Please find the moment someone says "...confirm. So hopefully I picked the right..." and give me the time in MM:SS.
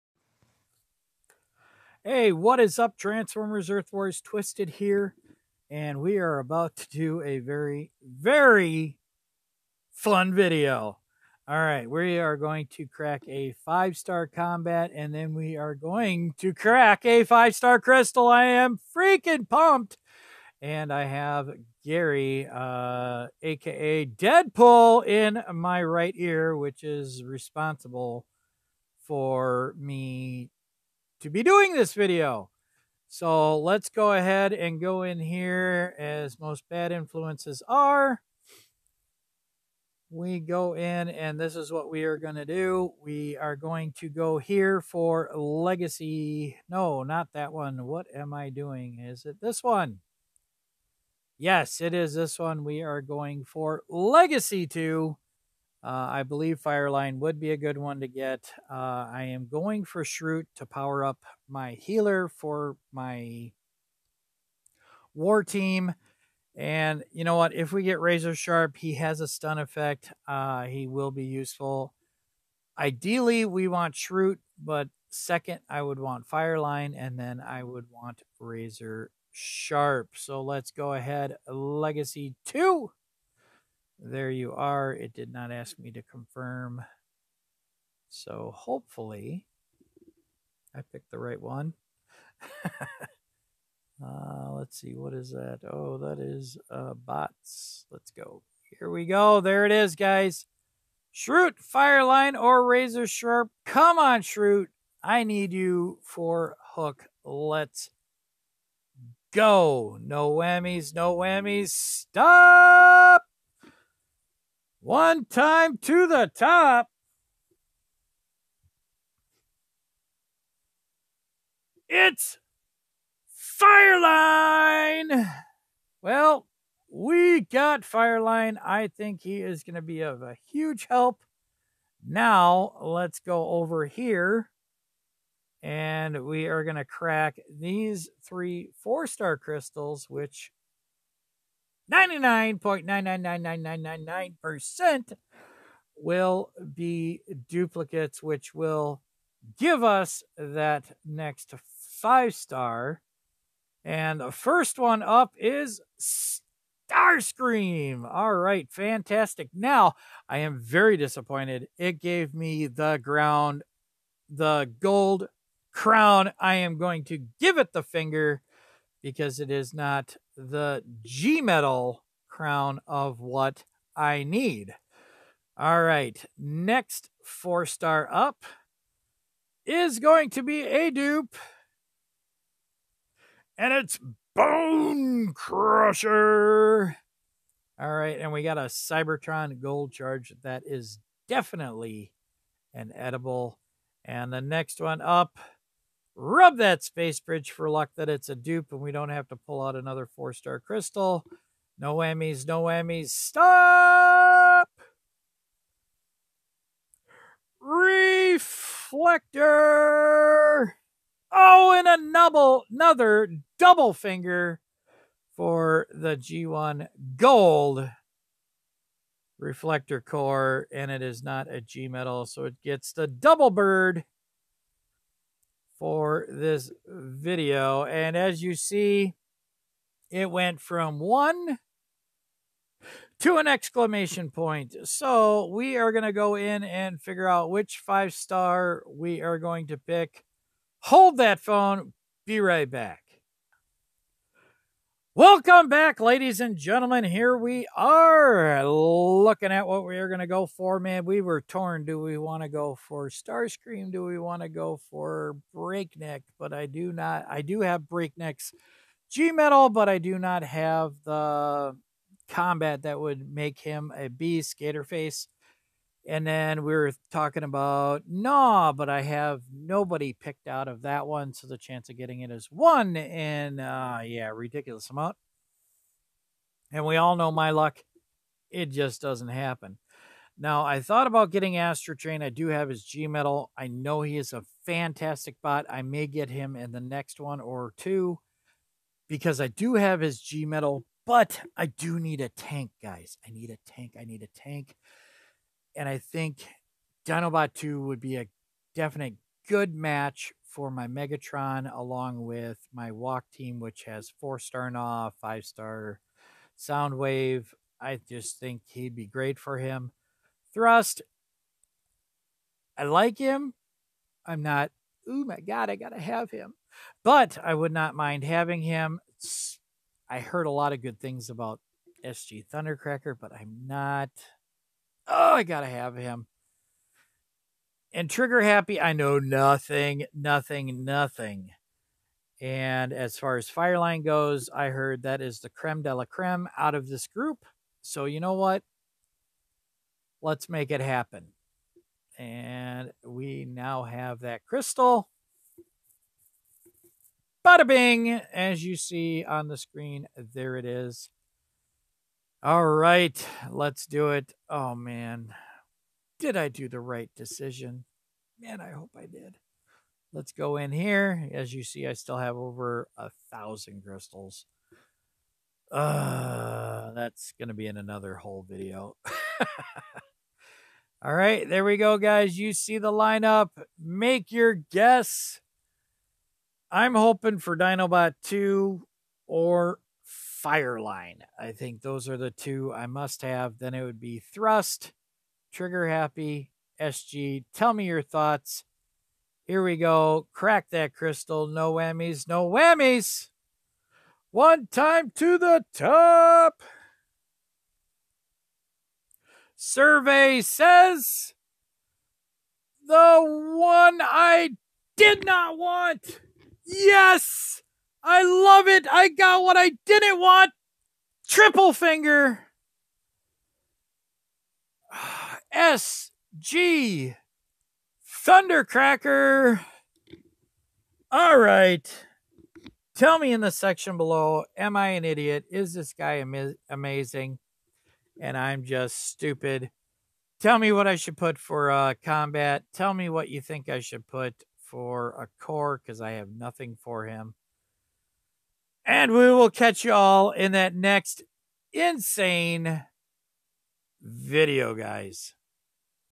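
01:26.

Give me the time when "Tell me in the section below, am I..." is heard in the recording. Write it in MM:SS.
07:02.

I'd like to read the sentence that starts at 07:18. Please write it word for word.
And we will catch y'all in that next insane video, guys.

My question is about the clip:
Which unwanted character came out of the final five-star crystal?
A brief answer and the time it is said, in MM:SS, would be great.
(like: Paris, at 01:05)
SG Thundercracker, at 06:55.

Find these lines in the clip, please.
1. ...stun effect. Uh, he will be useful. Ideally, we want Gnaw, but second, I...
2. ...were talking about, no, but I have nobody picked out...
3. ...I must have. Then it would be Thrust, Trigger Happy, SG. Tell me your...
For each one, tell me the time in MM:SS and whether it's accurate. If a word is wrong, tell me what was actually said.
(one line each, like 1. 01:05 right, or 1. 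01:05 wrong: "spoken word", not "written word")
1. 01:09 wrong: "Shroot", not "Gnaw"
2. 04:26 right
3. 06:22 right.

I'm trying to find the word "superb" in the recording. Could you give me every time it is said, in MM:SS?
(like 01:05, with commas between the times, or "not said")
not said.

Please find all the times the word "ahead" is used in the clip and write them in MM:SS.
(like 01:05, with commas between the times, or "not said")
00:34, 01:20.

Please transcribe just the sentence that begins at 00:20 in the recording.
And I have Gary, uh, aka Deadpool, in my right ear, which is responsible for me to be doing this video.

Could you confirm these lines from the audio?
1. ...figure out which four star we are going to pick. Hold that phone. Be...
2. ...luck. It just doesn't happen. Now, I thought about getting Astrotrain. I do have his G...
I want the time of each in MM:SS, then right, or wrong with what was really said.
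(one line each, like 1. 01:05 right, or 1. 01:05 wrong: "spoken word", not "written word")
1. 03:57 wrong: "five", not "four"
2. 04:37 right.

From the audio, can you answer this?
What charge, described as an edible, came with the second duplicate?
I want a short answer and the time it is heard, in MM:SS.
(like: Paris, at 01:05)
Cybertron gold charge, at 03:08.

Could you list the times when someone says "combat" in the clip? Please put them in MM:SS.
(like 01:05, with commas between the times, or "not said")
00:14, 04:22, 07:12.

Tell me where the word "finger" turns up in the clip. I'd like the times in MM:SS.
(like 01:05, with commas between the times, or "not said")
02:47, 03:33, 06:51.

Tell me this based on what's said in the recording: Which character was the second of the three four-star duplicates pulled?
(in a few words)
Bonecrusher.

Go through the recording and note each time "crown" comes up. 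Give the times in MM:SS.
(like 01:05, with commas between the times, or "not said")
02:45, 02:52.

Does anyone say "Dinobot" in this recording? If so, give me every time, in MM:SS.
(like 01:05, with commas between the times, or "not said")
04:57, 06:17.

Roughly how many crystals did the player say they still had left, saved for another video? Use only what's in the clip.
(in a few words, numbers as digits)
Over 1000.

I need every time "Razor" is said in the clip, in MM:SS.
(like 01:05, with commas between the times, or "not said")
01:07, 01:18, 01:42.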